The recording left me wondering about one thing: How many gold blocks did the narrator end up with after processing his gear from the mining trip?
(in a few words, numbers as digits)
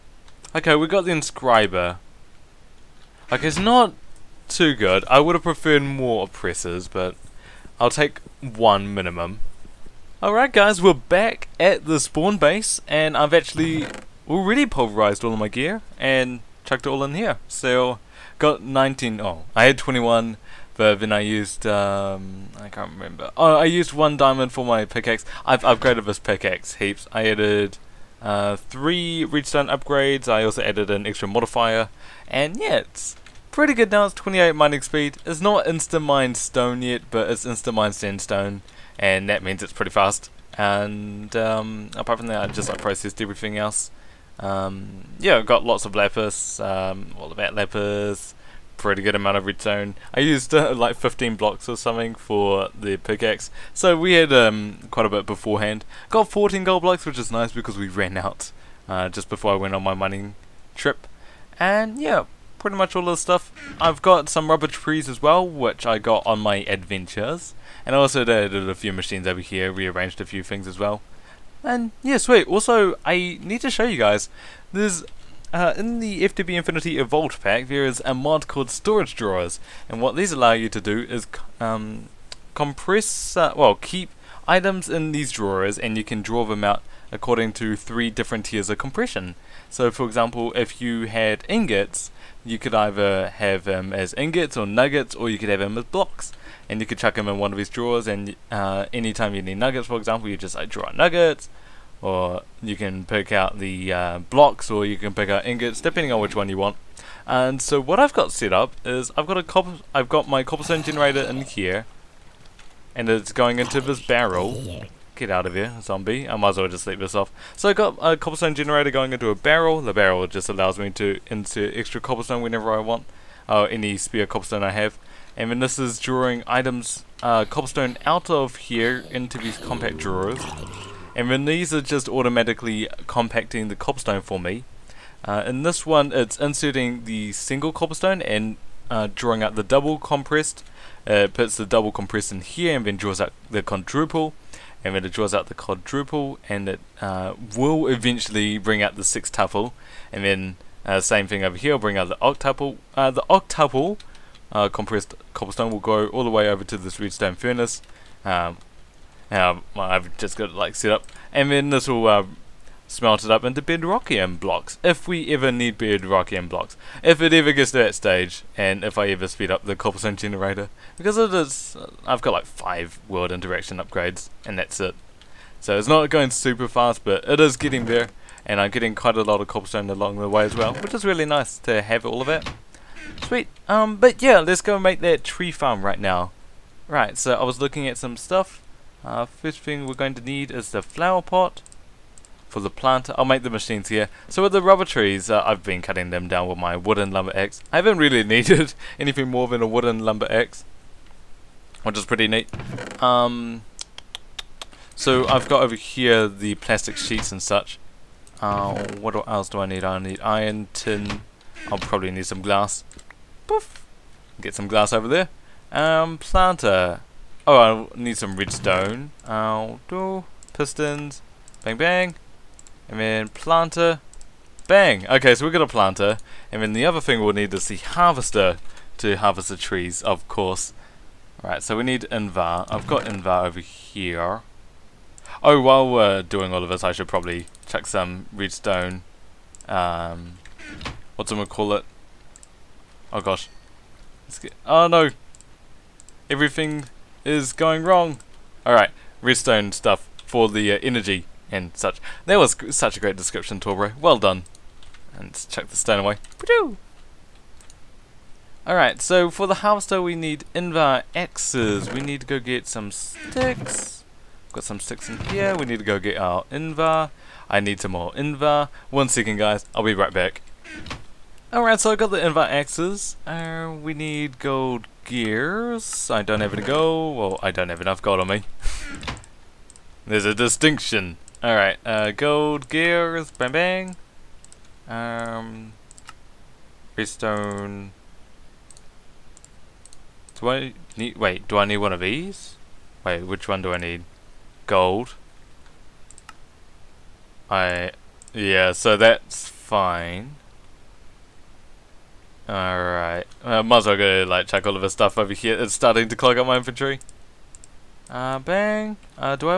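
14.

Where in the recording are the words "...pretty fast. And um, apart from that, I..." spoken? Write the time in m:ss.
0:39.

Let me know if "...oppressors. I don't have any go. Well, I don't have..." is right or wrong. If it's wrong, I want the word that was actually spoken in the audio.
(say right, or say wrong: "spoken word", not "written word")
wrong: "gears", not "oppressors".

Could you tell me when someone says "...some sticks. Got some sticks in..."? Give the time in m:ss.
4:22.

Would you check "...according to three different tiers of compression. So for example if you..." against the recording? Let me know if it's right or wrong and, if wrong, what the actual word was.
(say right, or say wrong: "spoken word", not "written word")
right.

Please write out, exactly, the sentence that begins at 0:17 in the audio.
So, got 19, oh, I had 21, but then I used, um, I can't remember.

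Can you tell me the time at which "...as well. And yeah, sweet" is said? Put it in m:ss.
1:10.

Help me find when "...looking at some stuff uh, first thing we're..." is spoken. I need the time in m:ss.
3:07.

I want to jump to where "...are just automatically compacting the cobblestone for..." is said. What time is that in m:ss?
2:11.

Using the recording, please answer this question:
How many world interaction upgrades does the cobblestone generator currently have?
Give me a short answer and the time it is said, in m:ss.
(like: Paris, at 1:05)
5, at 2:52.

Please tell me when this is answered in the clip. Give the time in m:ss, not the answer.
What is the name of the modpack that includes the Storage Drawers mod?
1:16.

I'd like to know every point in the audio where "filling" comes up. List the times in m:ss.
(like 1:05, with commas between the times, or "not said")
not said.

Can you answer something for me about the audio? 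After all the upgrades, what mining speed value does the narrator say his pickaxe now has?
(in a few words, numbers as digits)
28.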